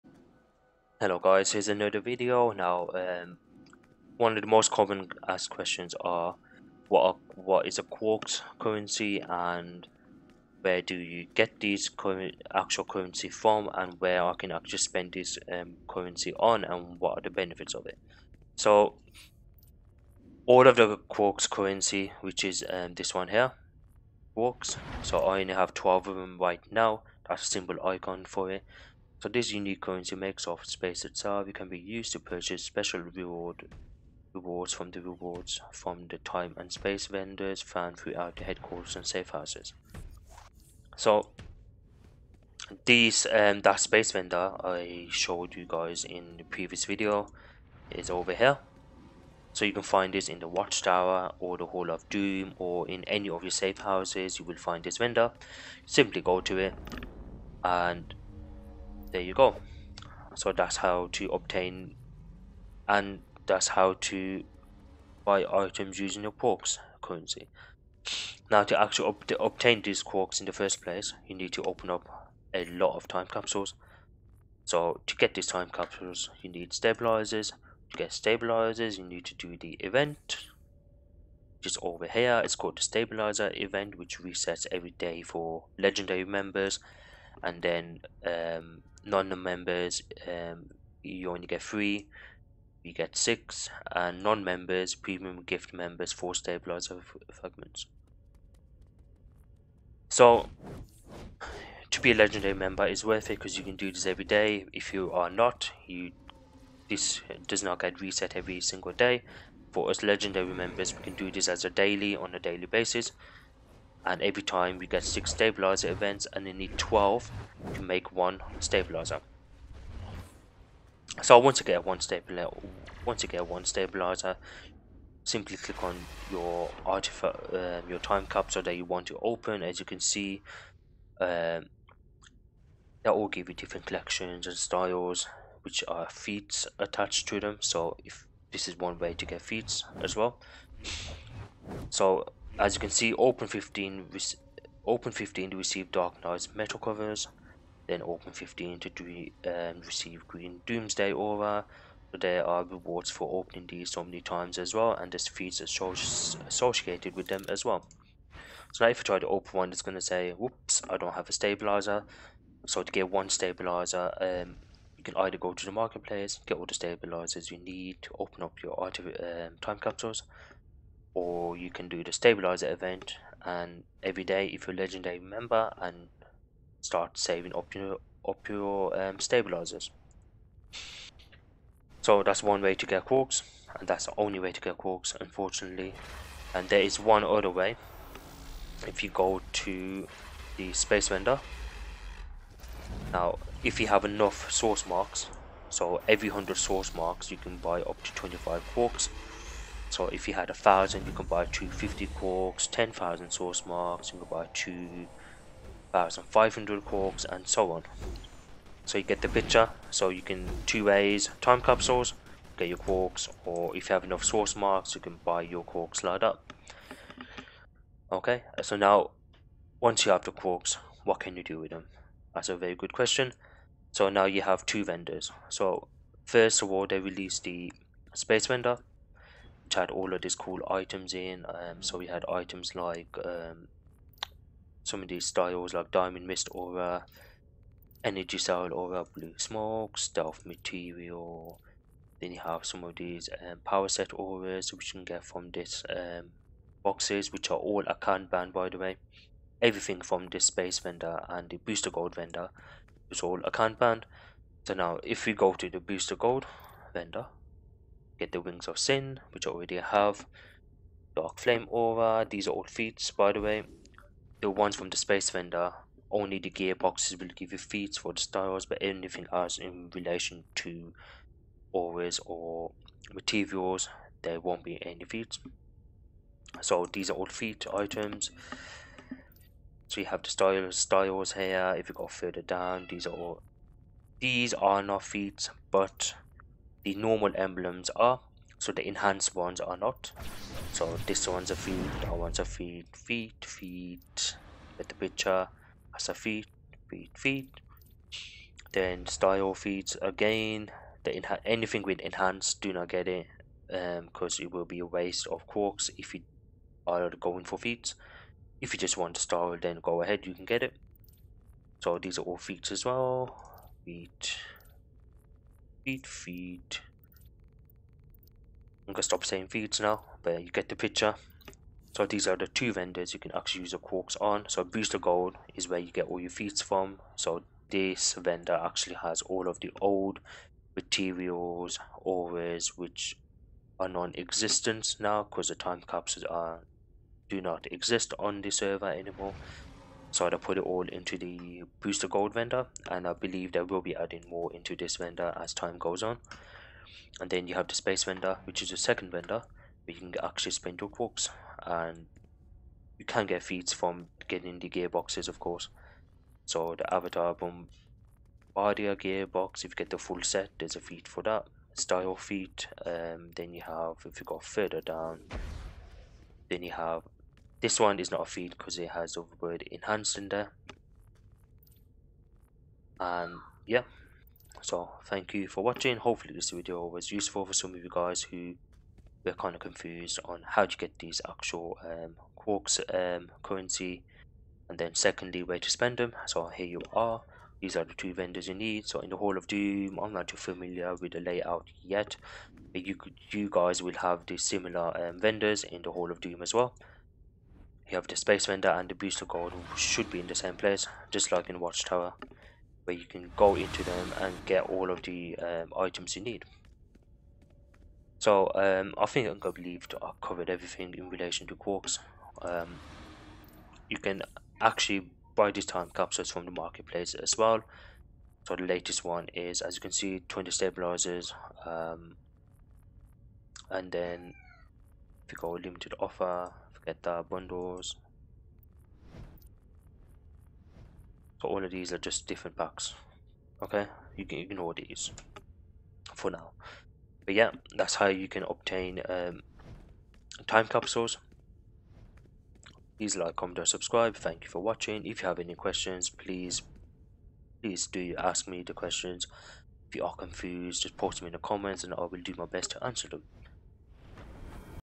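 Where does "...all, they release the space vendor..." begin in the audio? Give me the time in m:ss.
3:46.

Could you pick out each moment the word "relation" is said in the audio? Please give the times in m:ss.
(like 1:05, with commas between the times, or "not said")
4:29, 6:51.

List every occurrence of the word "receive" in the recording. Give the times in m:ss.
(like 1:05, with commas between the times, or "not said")
2:25, 2:29.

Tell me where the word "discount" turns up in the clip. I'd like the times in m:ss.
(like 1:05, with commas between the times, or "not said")
not said.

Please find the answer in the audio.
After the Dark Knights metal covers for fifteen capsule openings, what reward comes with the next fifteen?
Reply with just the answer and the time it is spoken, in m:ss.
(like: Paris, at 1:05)
green doomsday aura, at 2:30.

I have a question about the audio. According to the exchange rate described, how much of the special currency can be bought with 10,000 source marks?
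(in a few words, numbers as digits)
2,500.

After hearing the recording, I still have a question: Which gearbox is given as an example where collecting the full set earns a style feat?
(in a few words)
avatar bombardier gearbox.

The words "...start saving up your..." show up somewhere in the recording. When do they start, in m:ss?
2:56.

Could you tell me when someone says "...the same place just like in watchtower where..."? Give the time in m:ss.
6:40.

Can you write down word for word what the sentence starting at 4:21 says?
Dark Flame Aura, these are all feats by the way.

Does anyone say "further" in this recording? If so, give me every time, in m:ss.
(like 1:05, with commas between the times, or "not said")
4:42, 6:04.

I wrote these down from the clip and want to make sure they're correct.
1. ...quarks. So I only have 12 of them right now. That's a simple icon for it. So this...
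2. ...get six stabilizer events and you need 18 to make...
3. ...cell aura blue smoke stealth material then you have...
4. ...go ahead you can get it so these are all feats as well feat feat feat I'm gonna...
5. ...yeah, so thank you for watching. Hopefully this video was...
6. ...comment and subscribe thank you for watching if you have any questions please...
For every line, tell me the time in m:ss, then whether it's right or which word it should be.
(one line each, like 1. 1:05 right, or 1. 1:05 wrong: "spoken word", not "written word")
1. 0:24 right
2. 1:54 wrong: "12", not "18"
3. 3:58 right
4. 5:09 right
5. 6:13 right
6. 7:23 right.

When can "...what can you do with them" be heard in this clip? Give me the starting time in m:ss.
3:41.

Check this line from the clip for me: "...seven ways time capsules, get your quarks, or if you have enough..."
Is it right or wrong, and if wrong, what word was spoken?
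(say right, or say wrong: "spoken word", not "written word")
wrong: "two", not "seven".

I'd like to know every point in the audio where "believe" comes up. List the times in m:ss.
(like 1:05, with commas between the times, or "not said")
5:43, 6:49.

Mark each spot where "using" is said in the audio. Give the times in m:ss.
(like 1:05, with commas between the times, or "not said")
1:05.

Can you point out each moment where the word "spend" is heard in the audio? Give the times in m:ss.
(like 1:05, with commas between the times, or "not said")
0:14, 5:50, 6:25.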